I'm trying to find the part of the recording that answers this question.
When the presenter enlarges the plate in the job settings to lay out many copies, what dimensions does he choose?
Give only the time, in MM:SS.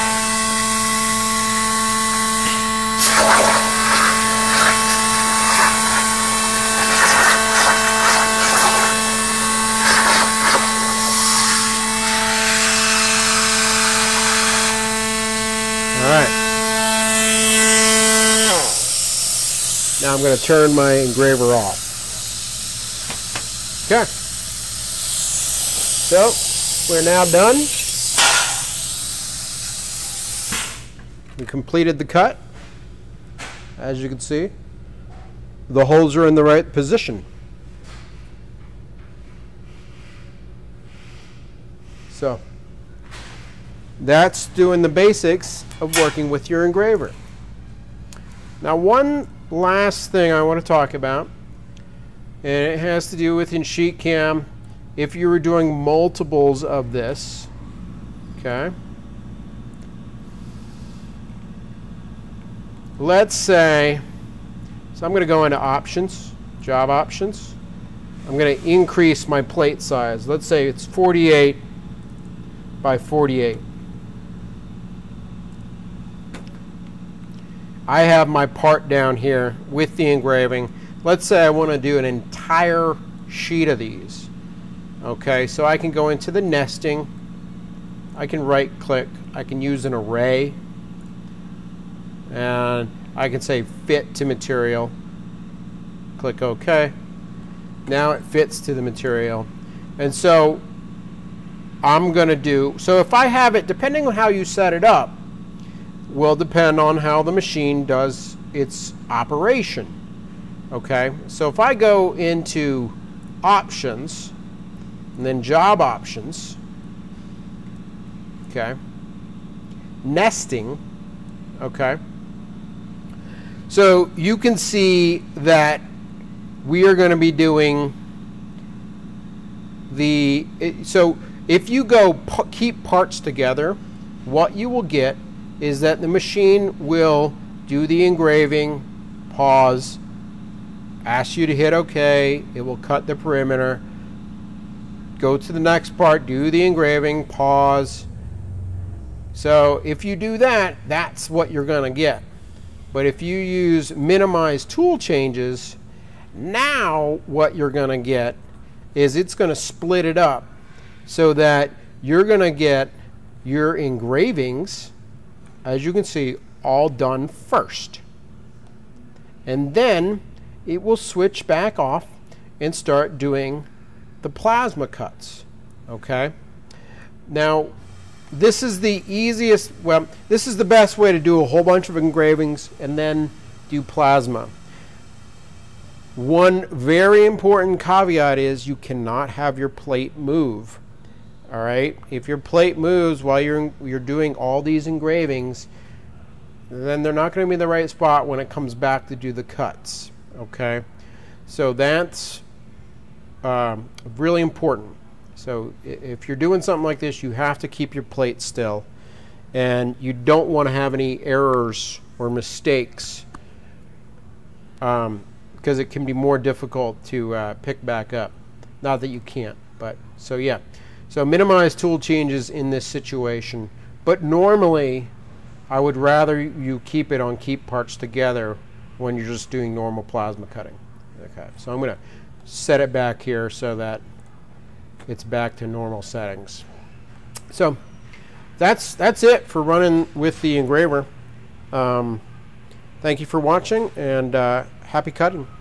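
01:10.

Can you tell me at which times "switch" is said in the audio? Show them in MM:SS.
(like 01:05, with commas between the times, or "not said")
02:50.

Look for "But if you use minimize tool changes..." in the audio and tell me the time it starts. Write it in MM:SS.
02:32.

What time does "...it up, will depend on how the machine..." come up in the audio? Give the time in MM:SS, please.
01:44.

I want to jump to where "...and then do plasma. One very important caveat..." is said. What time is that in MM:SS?
03:02.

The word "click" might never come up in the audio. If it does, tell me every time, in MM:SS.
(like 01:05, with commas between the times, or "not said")
01:28, 01:36.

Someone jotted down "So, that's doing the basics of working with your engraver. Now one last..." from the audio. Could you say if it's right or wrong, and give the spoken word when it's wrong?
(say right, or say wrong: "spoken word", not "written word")
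right.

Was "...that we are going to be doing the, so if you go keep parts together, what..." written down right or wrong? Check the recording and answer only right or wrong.
right.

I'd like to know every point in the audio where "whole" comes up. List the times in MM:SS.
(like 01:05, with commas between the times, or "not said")
03:01.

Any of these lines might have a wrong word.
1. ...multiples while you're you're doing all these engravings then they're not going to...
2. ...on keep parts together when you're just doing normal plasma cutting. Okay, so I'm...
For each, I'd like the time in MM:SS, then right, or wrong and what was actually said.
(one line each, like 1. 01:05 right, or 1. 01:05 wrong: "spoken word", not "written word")
1. 03:12 wrong: "moves", not "multiples"
2. 03:47 right.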